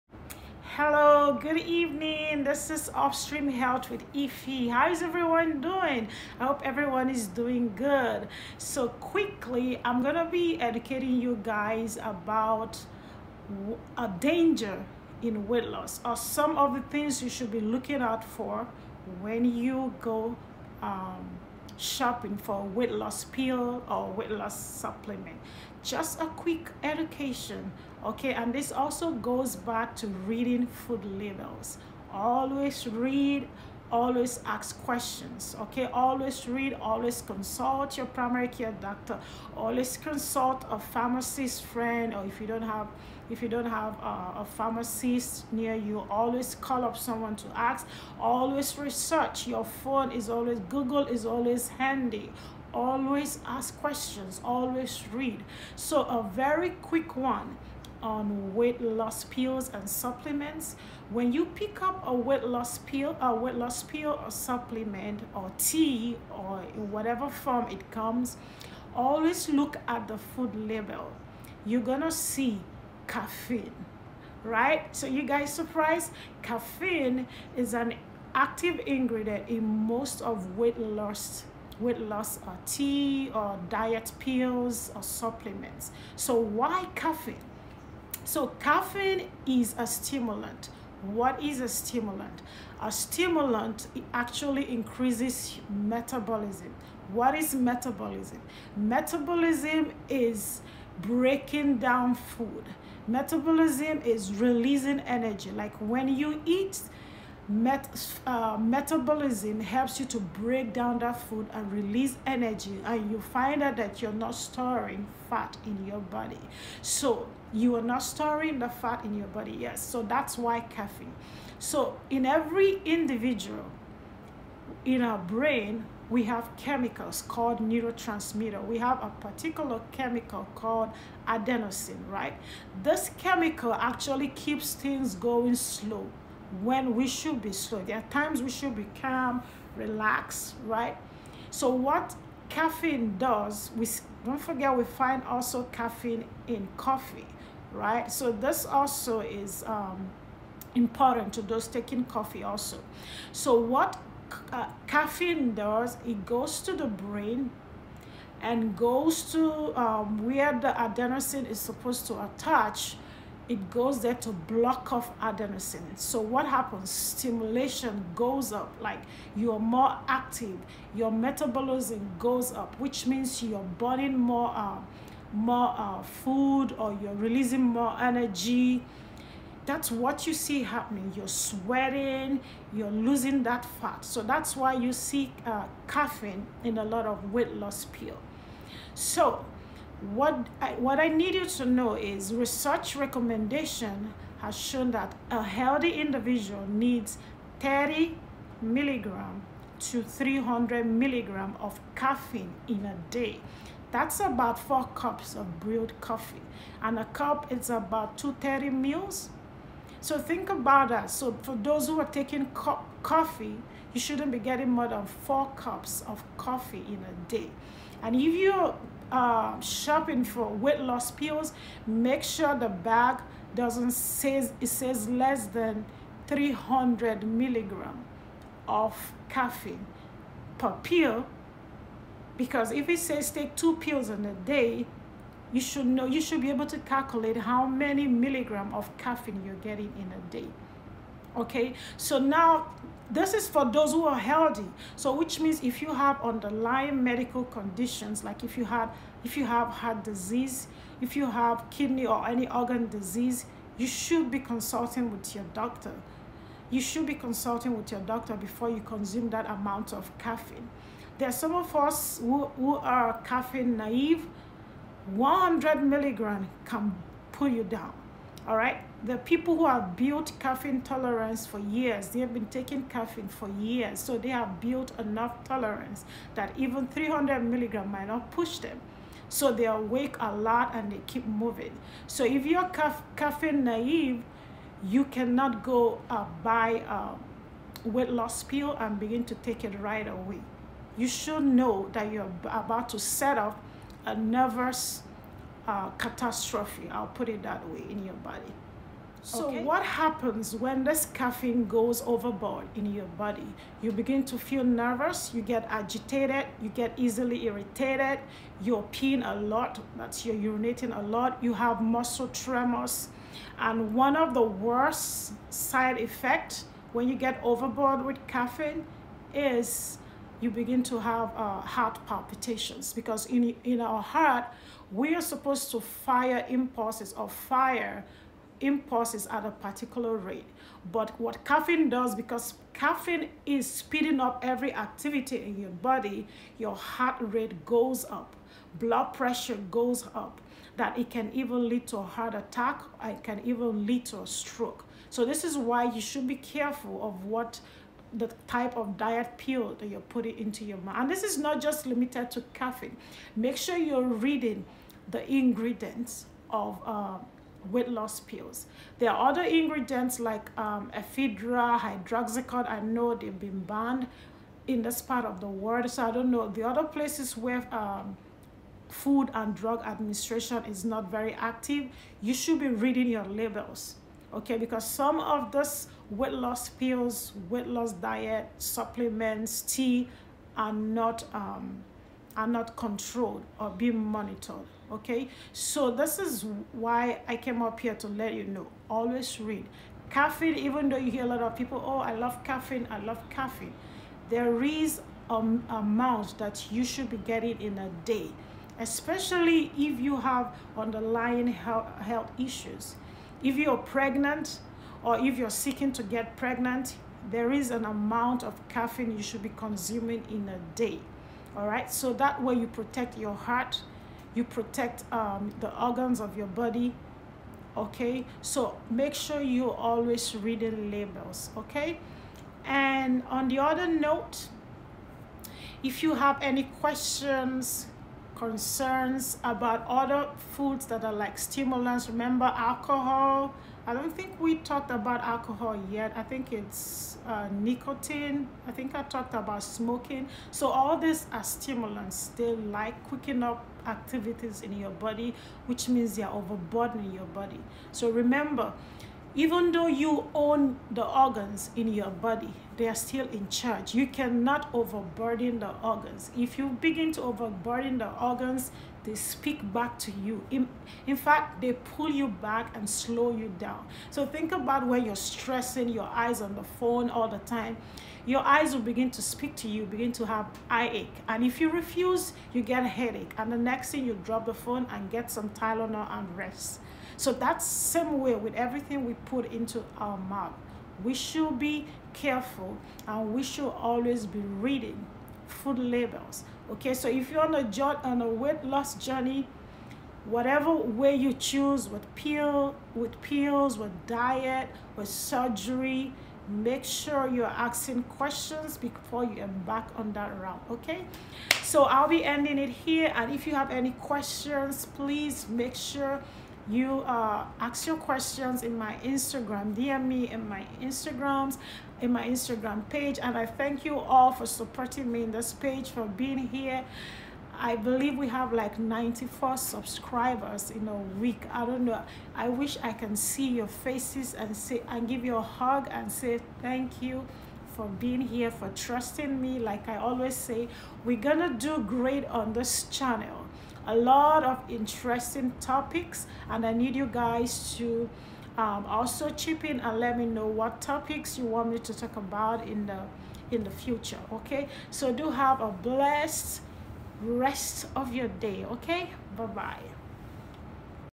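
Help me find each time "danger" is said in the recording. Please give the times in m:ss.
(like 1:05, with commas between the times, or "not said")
0:14.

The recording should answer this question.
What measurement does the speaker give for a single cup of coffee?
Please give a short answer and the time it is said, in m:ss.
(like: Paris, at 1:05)
230, at 3:28.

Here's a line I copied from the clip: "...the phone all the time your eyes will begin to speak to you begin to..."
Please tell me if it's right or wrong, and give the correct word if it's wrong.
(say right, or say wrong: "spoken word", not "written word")
right.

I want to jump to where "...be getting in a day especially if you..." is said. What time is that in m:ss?
6:37.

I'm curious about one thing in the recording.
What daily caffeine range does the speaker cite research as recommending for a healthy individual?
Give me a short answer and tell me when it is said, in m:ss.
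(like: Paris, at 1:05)
30 to 300 milligrams, at 3:17.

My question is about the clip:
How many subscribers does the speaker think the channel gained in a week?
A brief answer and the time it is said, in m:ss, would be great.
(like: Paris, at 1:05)
94, at 8:38.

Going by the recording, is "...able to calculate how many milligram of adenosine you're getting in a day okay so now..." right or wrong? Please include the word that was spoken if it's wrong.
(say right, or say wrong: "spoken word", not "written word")
wrong: "caffeine", not "adenosine".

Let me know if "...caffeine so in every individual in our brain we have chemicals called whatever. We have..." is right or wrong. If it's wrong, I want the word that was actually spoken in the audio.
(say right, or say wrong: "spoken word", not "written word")
wrong: "neurotransmitter", not "whatever".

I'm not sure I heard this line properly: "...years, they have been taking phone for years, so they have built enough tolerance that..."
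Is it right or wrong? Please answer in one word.
wrong.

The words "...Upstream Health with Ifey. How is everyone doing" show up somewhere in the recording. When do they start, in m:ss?
0:02.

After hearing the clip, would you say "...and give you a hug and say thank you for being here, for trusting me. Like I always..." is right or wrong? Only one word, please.
right.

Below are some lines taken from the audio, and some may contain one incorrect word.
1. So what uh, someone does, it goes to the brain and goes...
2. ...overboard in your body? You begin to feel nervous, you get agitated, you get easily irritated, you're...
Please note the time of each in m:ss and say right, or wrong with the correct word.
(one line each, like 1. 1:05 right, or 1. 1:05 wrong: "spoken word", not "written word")
1. 2:33 wrong: "caffeine", not "someone"
2. 5:02 right.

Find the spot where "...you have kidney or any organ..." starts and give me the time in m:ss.
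4:11.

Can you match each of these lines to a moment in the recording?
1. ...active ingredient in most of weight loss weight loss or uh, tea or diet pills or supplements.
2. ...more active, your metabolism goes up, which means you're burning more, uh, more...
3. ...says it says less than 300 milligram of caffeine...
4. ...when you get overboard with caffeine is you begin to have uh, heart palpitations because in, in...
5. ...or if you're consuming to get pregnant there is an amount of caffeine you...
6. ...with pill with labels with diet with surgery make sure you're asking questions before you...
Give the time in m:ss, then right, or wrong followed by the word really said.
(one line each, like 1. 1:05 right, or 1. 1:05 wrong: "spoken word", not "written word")
1. 1:18 right
2. 2:49 right
3. 3:43 right
4. 5:16 right
5. 6:45 wrong: "seeking", not "consuming"
6. 8:11 wrong: "pills", not "labels".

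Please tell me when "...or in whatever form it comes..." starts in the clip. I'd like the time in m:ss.
1:06.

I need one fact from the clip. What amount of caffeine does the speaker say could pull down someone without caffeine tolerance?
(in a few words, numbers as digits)
100 milligrams.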